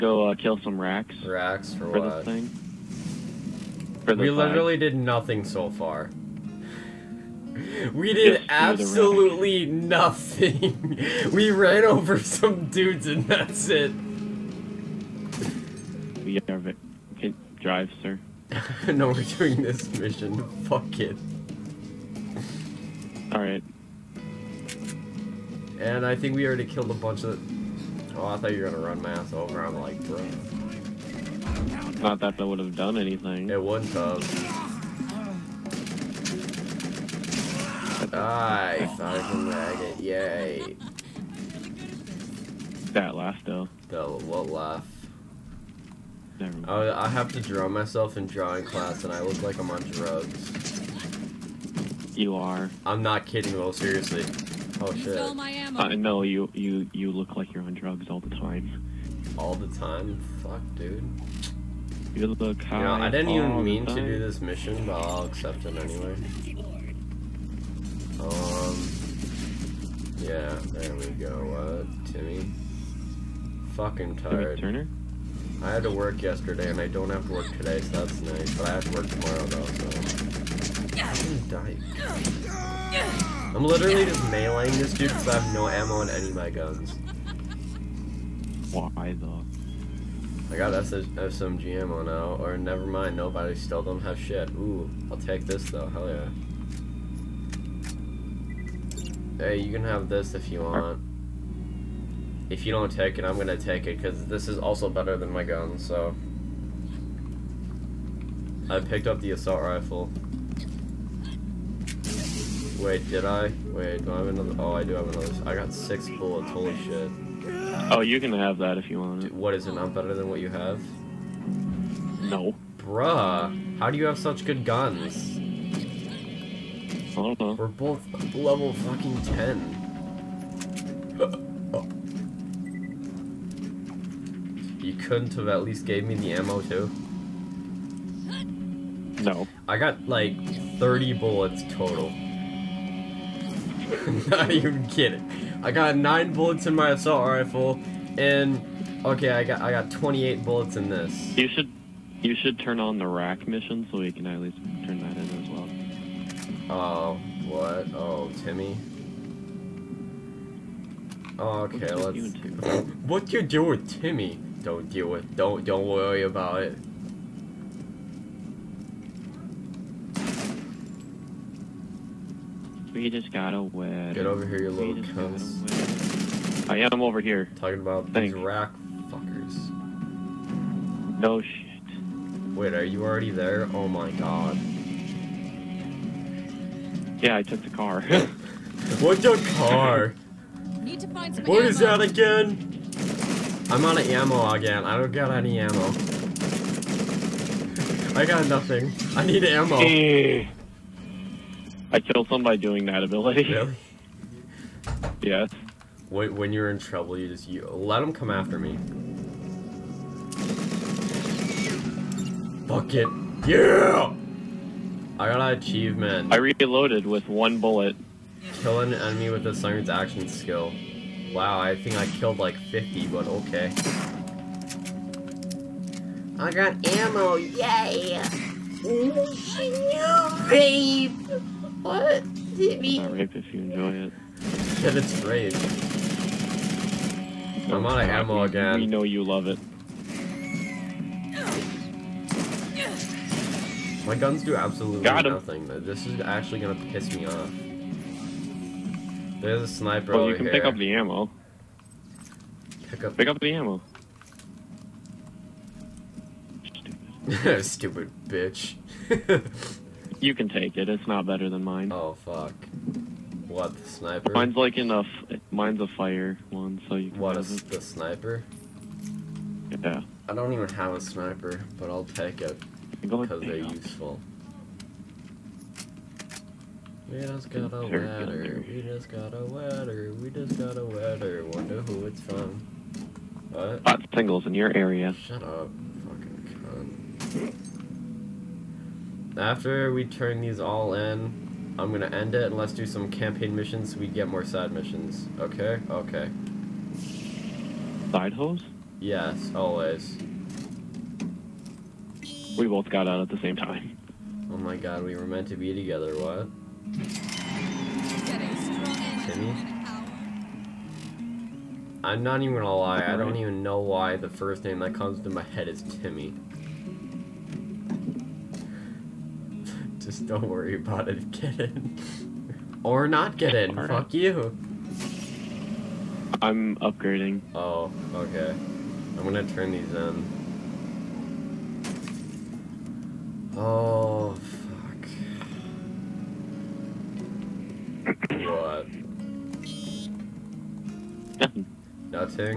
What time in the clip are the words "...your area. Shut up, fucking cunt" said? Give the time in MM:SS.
04:44.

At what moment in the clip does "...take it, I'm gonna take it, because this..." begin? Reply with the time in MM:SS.
01:42.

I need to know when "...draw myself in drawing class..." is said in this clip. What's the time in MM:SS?
00:47.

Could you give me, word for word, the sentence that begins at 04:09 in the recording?
There's a sniper well, you can here.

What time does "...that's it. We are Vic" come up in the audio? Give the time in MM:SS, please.
00:13.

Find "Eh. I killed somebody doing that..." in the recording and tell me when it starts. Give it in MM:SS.
03:19.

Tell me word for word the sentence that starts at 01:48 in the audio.
I picked up the assault rifle.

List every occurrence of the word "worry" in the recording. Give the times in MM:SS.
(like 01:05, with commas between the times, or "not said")
02:45, 05:20.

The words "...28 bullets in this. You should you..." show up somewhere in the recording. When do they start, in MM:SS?
02:29.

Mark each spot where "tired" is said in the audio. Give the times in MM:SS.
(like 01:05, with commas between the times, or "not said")
01:14.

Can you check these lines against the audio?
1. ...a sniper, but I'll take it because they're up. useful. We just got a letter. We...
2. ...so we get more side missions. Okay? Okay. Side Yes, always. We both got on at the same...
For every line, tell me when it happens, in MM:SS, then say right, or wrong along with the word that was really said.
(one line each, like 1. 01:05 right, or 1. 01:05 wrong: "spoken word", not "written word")
1. 04:30 right
2. 04:53 right.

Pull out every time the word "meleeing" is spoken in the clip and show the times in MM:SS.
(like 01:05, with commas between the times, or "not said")
01:24.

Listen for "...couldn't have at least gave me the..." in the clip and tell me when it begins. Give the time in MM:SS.
02:14.